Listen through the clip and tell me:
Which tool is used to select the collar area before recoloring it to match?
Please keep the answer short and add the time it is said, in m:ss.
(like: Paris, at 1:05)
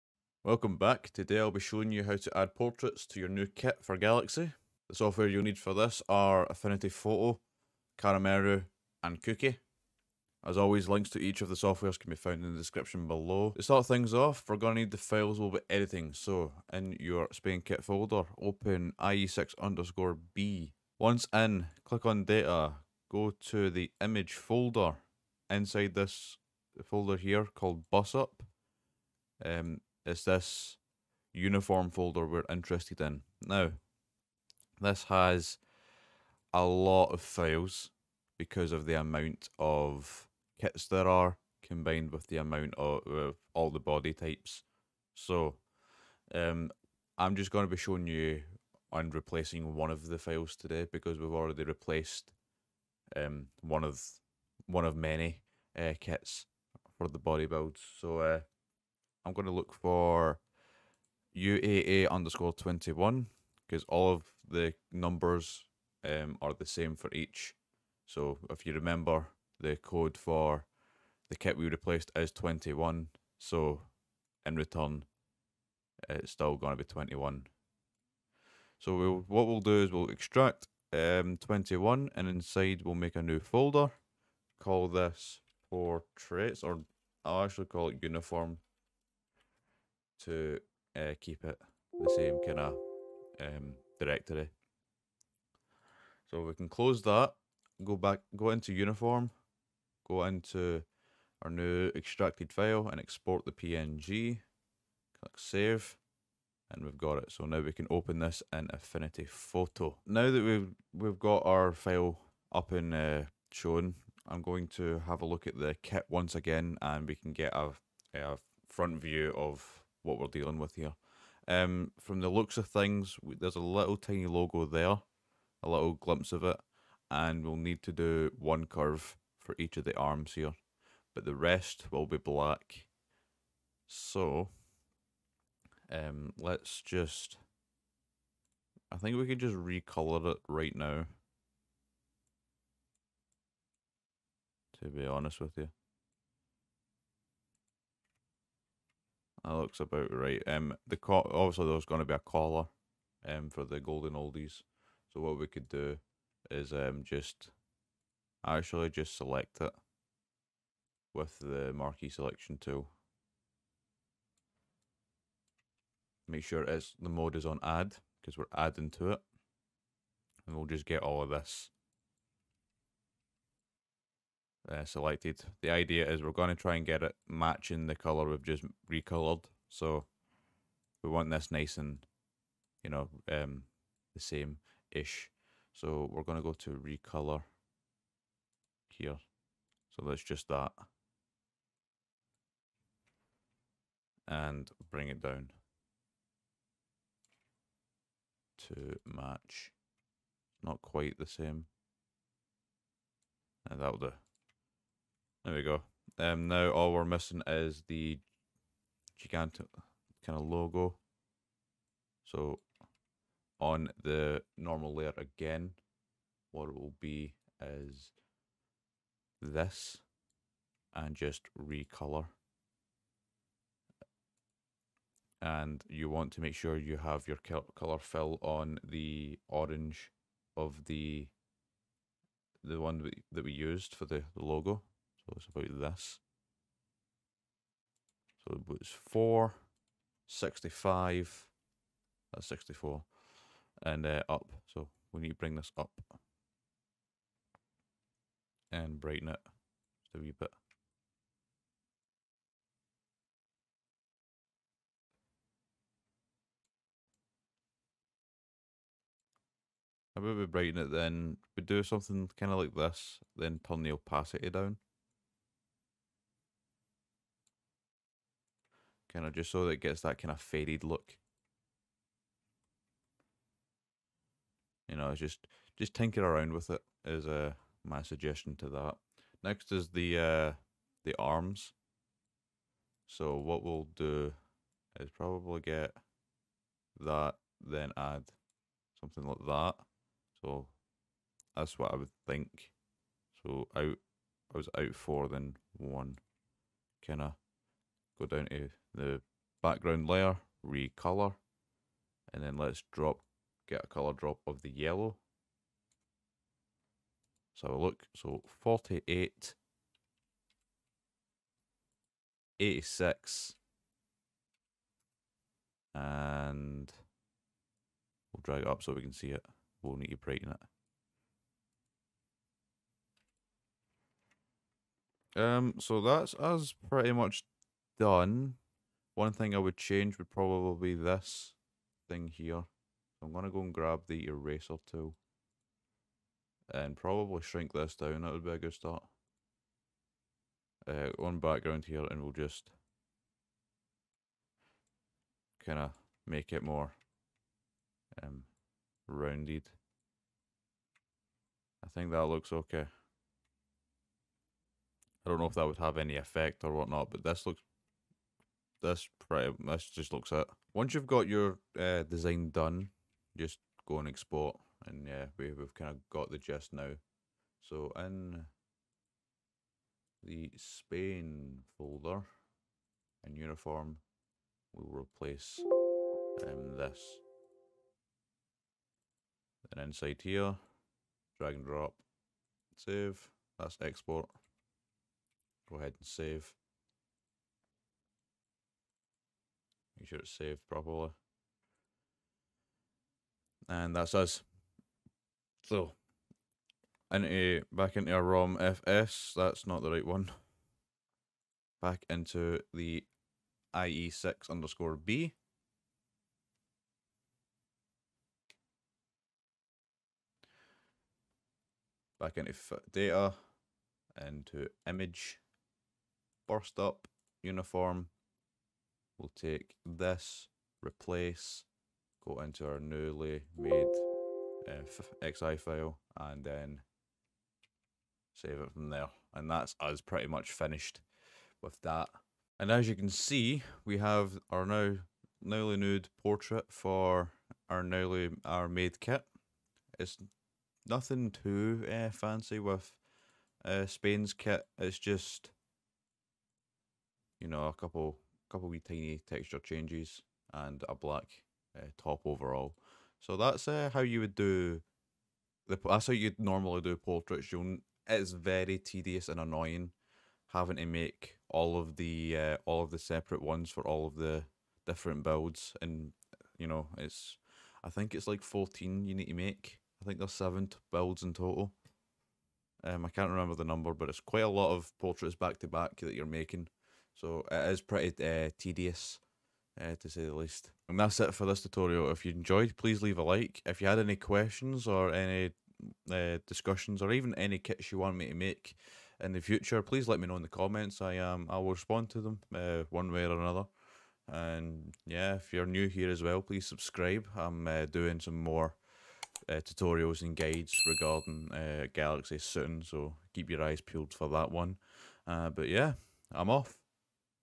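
marquee selection tool, at 2:41.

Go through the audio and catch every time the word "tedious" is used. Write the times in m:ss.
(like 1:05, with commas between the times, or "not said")
7:38, 7:58.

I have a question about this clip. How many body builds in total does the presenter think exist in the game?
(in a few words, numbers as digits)
7.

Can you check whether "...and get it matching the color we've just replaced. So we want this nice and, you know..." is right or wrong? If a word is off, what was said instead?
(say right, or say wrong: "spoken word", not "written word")
wrong: "recolored", not "replaced".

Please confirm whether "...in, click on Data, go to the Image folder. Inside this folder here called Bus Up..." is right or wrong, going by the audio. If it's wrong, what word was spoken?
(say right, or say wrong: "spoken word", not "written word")
right.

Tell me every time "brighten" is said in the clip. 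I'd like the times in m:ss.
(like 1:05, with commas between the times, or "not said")
4:09, 4:20, 5:20.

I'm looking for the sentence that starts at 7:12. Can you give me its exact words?
And as you can see, we have our now newly nude portrait for our newly our made kit.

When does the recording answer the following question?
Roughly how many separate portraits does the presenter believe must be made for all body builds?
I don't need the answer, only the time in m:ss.
7:48.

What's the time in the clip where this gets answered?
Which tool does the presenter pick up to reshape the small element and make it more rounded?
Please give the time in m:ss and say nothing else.
5:34.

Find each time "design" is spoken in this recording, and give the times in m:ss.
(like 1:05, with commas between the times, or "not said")
6:02.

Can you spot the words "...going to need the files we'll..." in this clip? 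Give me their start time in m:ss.
0:14.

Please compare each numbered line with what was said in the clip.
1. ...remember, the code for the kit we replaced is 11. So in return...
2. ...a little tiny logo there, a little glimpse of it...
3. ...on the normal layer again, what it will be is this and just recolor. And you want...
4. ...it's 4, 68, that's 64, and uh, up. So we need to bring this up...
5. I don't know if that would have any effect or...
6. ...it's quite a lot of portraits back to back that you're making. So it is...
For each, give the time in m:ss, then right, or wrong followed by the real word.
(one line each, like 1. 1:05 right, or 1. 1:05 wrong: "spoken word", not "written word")
1. 1:08 wrong: "21", not "11"
2. 2:03 right
3. 3:33 right
4. 3:58 wrong: "65", not "68"
5. 5:55 right
6. 7:54 right.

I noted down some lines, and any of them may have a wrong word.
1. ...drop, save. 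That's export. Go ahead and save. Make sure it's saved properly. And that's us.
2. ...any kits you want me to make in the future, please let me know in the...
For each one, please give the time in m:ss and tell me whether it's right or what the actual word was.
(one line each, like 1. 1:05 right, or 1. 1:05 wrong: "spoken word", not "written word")
1. 6:21 right
2. 8:07 right.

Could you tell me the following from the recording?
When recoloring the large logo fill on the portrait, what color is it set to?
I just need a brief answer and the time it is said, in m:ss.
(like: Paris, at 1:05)
orange, at 3:49.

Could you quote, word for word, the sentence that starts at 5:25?
Um, so that's us pretty much done.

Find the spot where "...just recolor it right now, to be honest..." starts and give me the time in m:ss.
2:19.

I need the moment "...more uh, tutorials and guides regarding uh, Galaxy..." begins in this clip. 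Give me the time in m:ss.
8:18.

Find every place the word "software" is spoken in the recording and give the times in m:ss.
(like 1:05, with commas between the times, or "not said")
0:04, 0:11.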